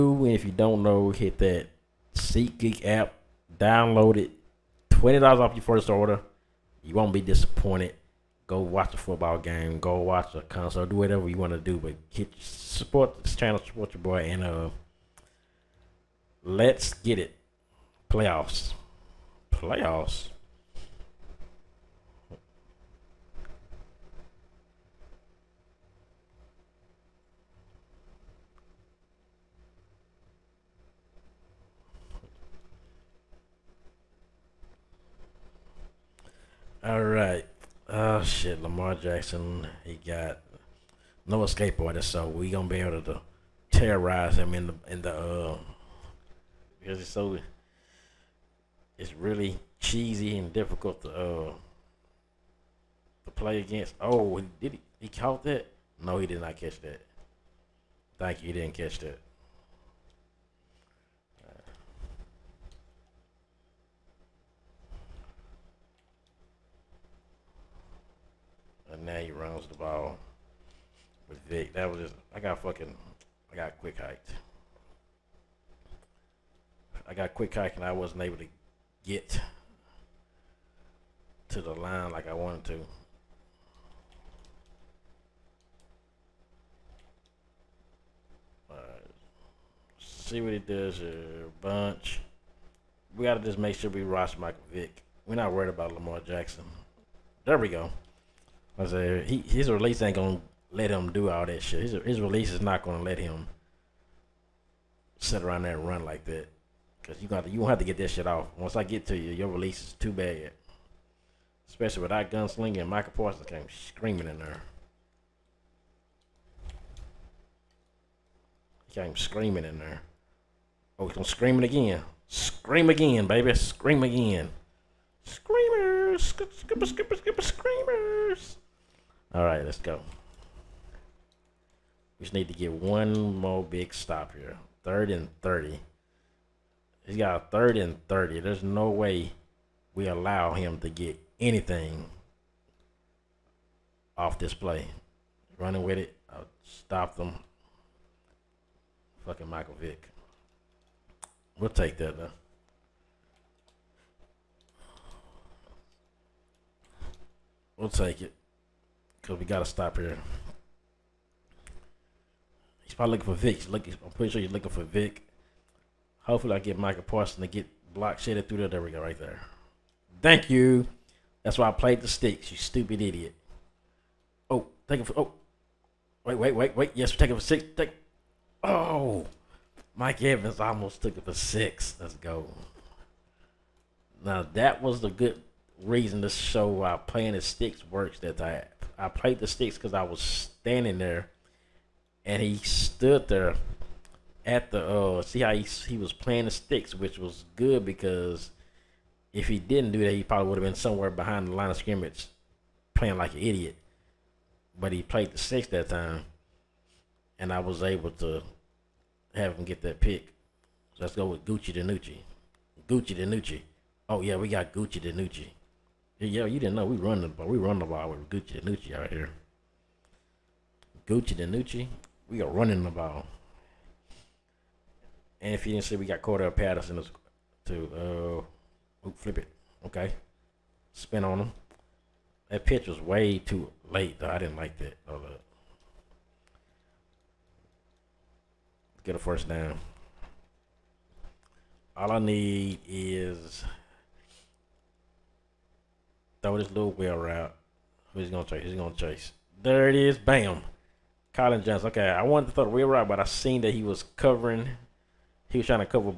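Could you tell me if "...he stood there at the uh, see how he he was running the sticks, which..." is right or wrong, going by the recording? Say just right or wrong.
wrong.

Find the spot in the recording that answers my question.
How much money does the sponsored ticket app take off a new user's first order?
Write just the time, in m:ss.
0:04.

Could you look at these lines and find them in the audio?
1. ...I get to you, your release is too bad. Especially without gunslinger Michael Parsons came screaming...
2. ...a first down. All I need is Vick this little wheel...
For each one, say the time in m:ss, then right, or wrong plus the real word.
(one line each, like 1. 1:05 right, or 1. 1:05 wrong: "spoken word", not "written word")
1. 1:48 right
2. 3:59 wrong: "Throw", not "Vick".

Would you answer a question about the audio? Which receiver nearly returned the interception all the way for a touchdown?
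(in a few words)
Mike Evans.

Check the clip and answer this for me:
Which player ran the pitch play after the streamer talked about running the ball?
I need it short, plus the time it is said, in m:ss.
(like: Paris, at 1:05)
Cordell Patterson, at 3:46.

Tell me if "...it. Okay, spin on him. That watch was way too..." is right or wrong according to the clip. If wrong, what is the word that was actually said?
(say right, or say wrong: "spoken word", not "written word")
wrong: "pitch", not "watch".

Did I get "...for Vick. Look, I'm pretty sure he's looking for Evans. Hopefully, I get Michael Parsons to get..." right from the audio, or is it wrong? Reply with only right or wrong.
wrong.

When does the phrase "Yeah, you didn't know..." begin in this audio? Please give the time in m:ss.
3:36.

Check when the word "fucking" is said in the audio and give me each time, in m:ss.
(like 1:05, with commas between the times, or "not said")
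1:12, 2:29.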